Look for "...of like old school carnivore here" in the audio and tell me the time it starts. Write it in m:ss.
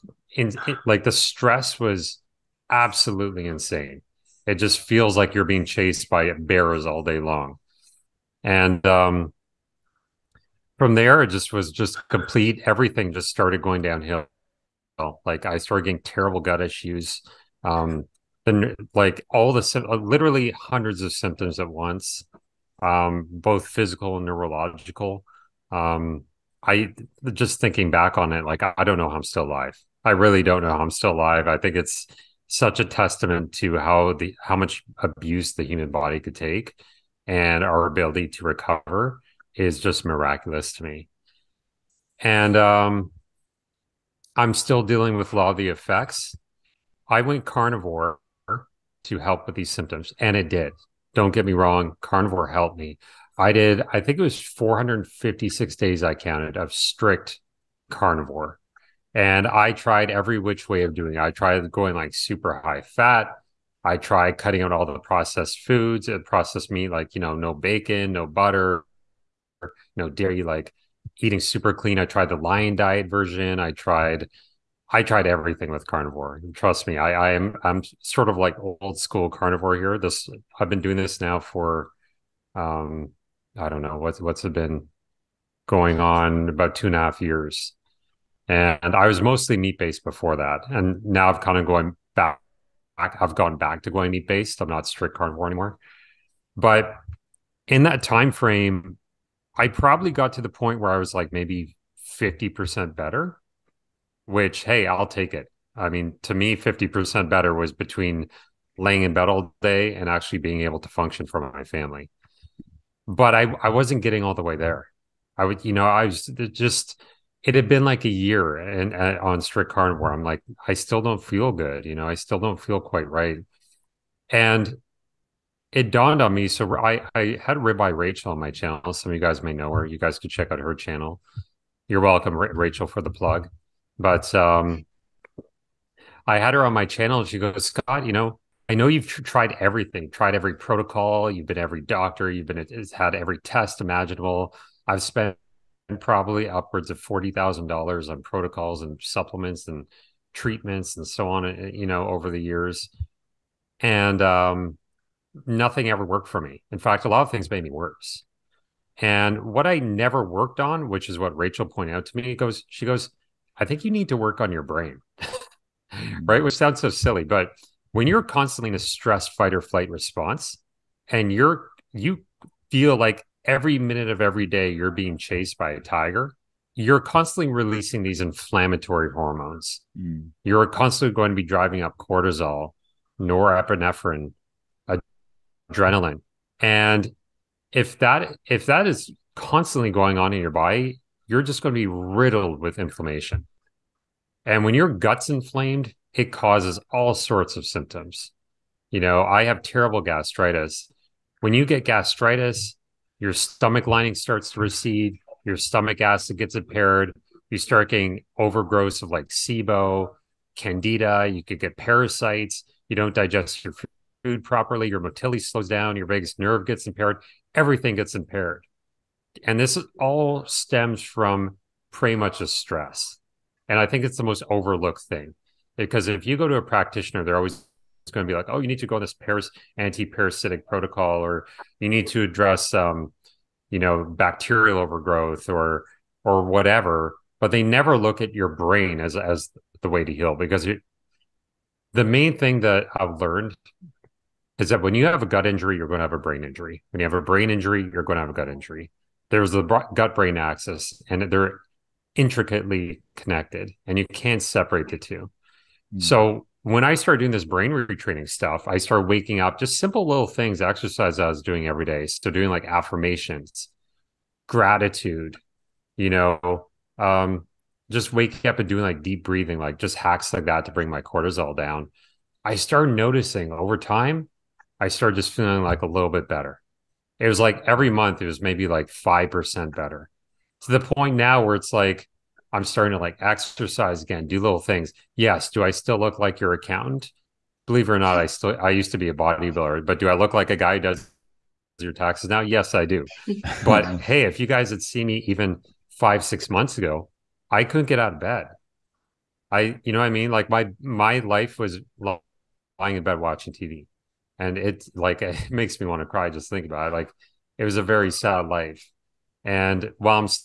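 1:18.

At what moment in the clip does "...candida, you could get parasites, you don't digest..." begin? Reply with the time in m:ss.
3:30.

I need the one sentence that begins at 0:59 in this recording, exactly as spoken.
And I tried every which way of doing it.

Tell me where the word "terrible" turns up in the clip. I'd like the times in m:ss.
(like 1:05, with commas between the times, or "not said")
0:16, 3:19.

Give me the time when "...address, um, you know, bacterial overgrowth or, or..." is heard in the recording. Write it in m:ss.
3:52.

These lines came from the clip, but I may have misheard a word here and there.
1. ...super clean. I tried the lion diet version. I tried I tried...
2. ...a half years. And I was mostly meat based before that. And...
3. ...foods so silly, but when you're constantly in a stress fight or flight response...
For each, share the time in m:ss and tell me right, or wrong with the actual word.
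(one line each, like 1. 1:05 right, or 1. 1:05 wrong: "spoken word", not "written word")
1. 1:11 right
2. 1:26 right
3. 2:46 wrong: "sounds", not "foods".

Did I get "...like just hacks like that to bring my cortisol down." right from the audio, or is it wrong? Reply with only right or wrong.
right.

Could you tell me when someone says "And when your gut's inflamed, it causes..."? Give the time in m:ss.
3:14.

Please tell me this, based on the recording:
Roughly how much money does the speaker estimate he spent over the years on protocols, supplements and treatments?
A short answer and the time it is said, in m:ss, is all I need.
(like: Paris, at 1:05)
$40,000, at 2:27.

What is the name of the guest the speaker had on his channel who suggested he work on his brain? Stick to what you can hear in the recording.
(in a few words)
Ribeye Rachel.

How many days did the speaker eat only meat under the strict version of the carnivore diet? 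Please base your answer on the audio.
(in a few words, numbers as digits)
456.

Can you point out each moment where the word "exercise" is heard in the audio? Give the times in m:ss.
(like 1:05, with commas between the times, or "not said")
4:20, 4:43.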